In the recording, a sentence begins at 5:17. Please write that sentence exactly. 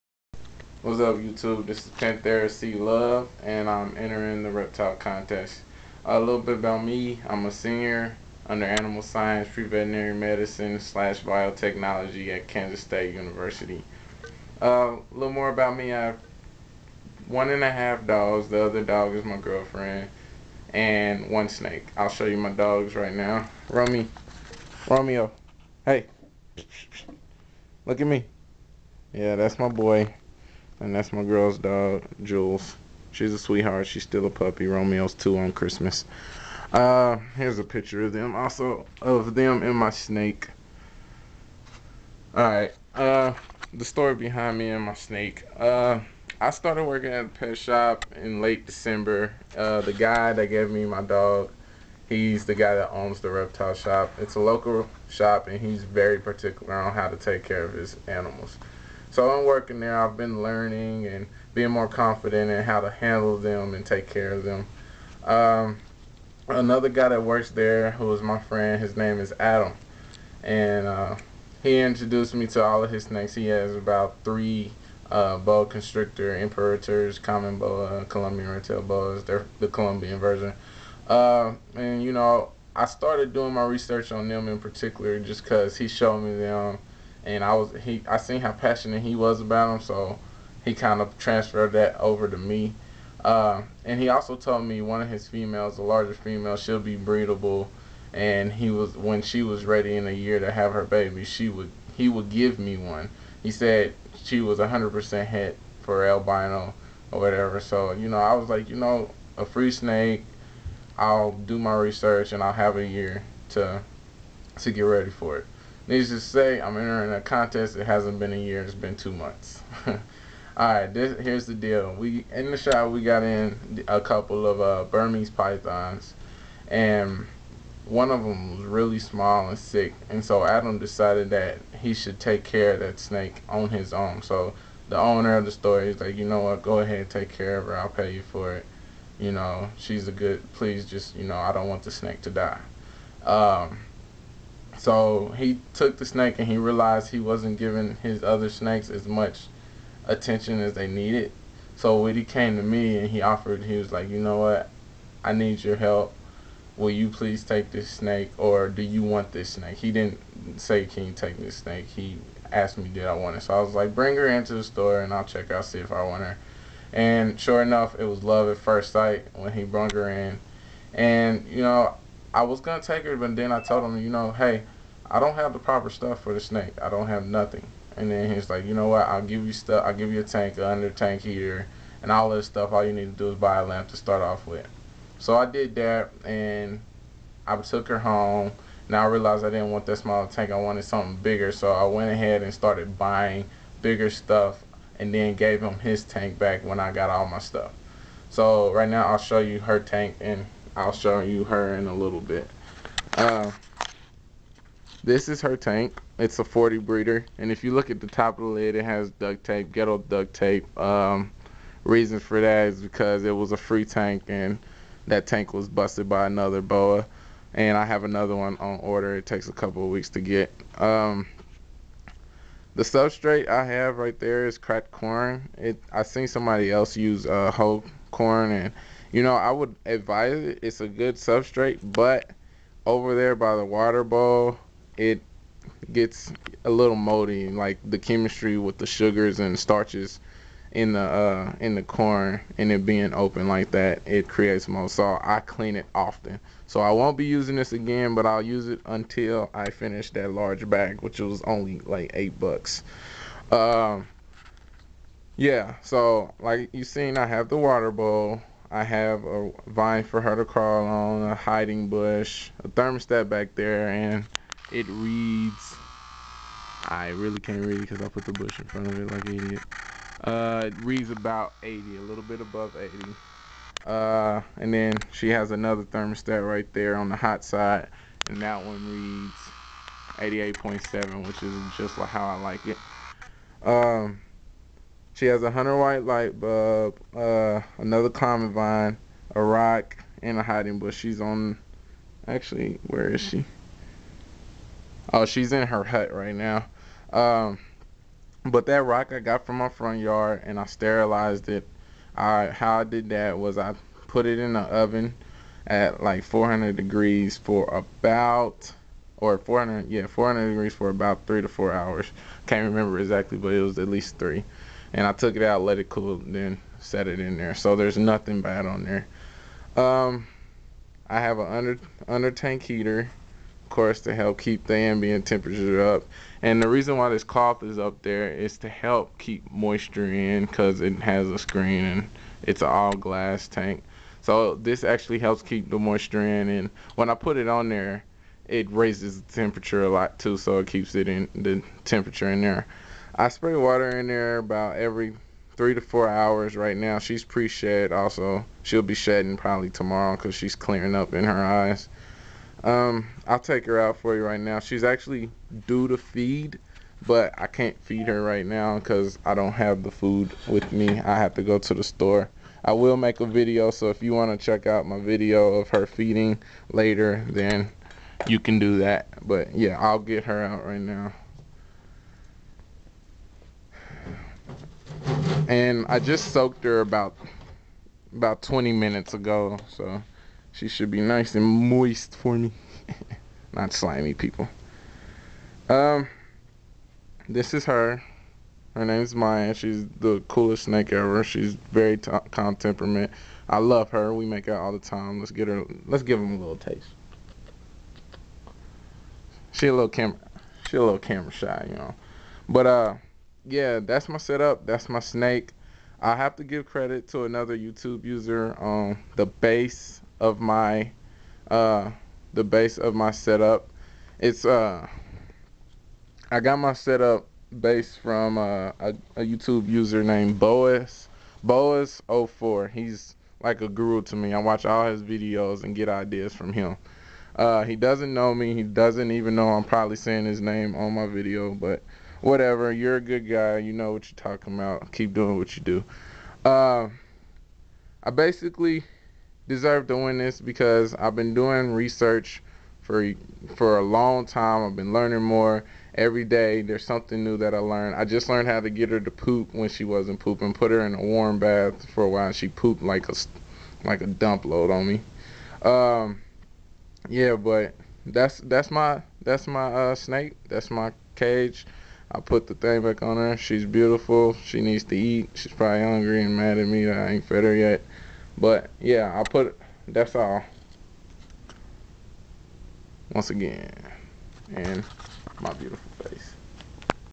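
So there's nothing bad on there.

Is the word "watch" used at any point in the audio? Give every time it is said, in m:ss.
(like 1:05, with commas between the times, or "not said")
7:04.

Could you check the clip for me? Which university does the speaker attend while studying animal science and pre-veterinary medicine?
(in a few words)
Kansas State University.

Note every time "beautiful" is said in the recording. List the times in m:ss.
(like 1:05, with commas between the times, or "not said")
7:43, 7:55.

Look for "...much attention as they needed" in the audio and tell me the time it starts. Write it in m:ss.
2:29.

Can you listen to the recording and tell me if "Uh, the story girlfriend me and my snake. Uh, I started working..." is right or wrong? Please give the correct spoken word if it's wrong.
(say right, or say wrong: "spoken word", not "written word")
wrong: "behind", not "girlfriend".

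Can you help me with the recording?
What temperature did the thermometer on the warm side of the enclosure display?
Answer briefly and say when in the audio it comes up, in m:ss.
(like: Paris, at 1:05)
88.7, at 4:40.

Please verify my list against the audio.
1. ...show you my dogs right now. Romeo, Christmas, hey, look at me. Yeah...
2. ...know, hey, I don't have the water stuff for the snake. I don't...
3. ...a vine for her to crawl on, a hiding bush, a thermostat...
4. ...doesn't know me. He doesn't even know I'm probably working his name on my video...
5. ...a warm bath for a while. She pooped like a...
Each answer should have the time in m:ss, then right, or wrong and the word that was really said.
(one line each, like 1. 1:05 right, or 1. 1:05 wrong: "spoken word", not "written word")
1. 0:22 wrong: "Romeo", not "Christmas"
2. 2:54 wrong: "proper", not "water"
3. 4:19 right
4. 7:07 wrong: "saying", not "working"
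5. 7:30 right.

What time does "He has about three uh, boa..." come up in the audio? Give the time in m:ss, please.
1:13.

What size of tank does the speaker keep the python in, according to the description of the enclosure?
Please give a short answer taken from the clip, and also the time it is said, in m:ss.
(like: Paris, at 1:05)
40 breeder, at 3:26.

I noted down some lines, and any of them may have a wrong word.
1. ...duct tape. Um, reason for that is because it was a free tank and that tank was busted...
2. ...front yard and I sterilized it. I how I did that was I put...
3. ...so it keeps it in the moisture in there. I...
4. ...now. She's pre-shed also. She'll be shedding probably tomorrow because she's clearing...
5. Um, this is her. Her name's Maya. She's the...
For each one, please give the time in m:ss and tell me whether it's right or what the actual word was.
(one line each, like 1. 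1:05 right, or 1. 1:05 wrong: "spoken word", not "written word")
1. 3:29 right
2. 4:59 right
3. 5:40 wrong: "temperature", not "moisture"
4. 5:46 right
5. 6:25 right.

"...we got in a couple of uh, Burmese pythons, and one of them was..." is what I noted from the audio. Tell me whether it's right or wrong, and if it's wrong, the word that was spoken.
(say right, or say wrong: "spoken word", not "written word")
right.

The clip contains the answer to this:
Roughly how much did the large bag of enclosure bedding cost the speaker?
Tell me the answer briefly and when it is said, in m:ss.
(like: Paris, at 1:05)
8 dollars, at 4:12.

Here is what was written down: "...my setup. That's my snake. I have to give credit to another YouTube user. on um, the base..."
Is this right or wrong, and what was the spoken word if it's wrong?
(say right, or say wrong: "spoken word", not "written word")
right.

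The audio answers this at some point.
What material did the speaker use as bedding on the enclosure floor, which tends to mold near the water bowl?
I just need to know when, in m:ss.
3:44.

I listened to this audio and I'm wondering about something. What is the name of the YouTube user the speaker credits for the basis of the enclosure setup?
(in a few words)
Boas04.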